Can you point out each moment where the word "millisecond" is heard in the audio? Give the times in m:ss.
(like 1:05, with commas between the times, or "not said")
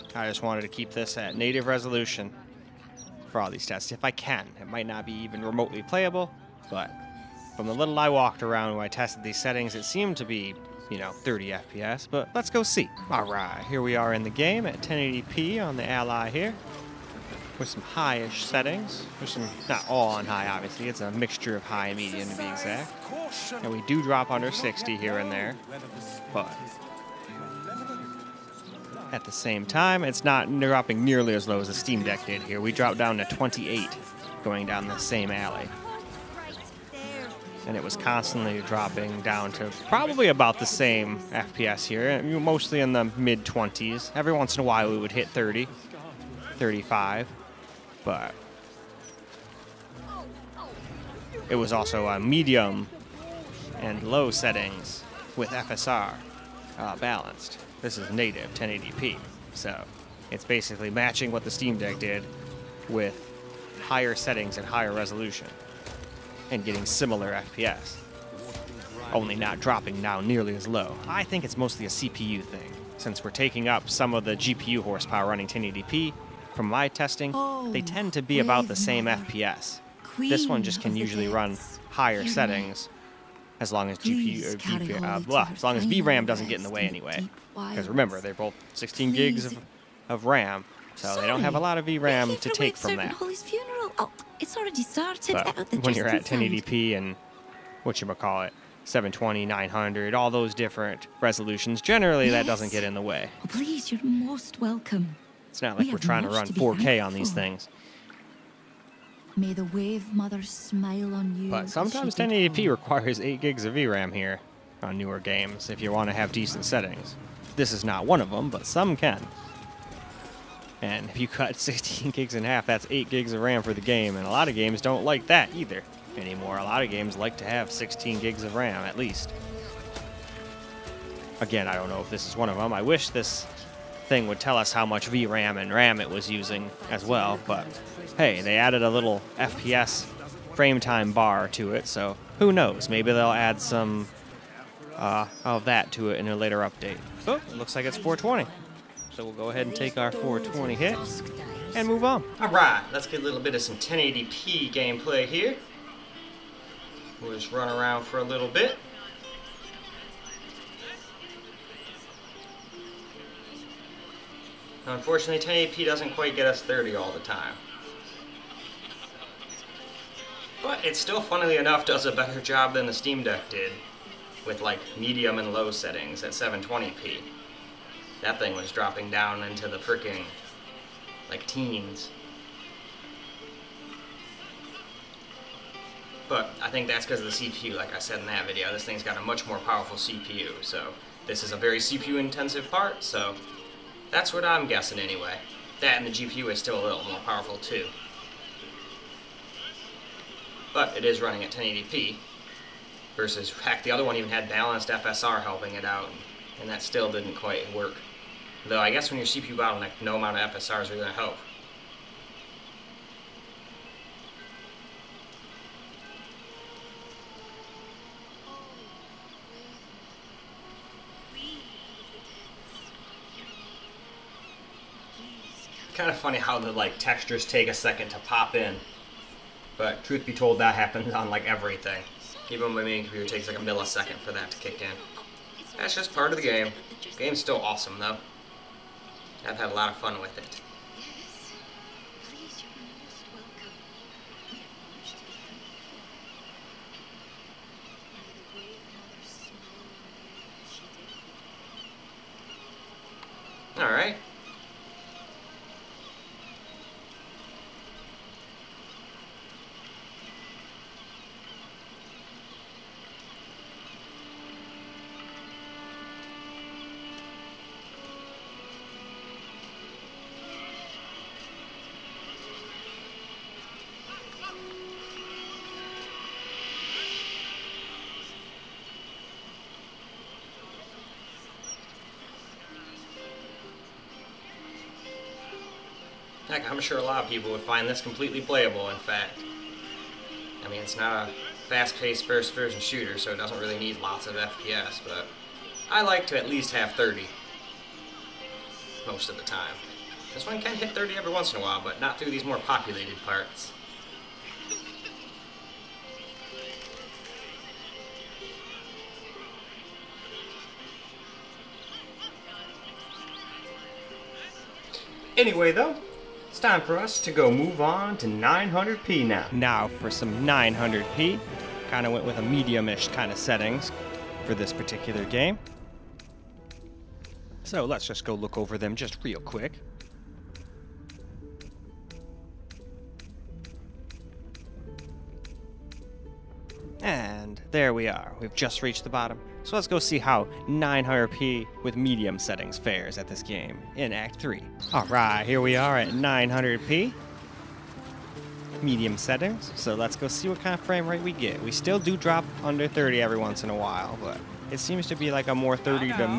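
3:53.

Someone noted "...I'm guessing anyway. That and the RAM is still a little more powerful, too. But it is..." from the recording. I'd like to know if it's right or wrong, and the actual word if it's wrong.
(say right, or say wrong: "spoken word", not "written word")
wrong: "GPU", not "RAM".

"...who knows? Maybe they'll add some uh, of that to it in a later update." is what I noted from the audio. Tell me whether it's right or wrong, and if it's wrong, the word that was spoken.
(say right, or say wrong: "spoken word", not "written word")
right.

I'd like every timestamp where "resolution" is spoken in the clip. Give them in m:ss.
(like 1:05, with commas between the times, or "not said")
0:01, 1:04, 1:41.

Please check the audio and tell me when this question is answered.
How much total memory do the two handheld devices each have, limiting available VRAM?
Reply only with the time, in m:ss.
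1:28.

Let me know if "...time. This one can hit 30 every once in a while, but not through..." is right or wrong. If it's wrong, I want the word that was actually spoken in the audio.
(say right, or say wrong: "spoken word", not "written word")
right.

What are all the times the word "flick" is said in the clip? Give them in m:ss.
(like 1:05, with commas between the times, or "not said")
not said.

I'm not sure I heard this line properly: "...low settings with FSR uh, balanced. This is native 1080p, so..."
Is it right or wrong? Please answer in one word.
right.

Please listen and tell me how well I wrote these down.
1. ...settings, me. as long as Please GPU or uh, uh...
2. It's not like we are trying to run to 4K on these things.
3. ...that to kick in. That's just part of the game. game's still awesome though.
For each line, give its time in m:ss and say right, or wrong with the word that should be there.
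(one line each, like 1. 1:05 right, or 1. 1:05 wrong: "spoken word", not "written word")
1. 1:22 right
2. 1:45 right
3. 3:54 right.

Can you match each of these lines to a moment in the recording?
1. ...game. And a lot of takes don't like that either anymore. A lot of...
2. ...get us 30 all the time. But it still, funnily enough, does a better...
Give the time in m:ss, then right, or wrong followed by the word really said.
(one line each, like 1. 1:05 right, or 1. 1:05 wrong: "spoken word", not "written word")
1. 2:03 wrong: "games", not "takes"
2. 2:46 right.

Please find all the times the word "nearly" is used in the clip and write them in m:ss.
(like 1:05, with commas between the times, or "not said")
0:31, 1:10.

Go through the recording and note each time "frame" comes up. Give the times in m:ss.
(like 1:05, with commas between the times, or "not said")
2:20, 5:50.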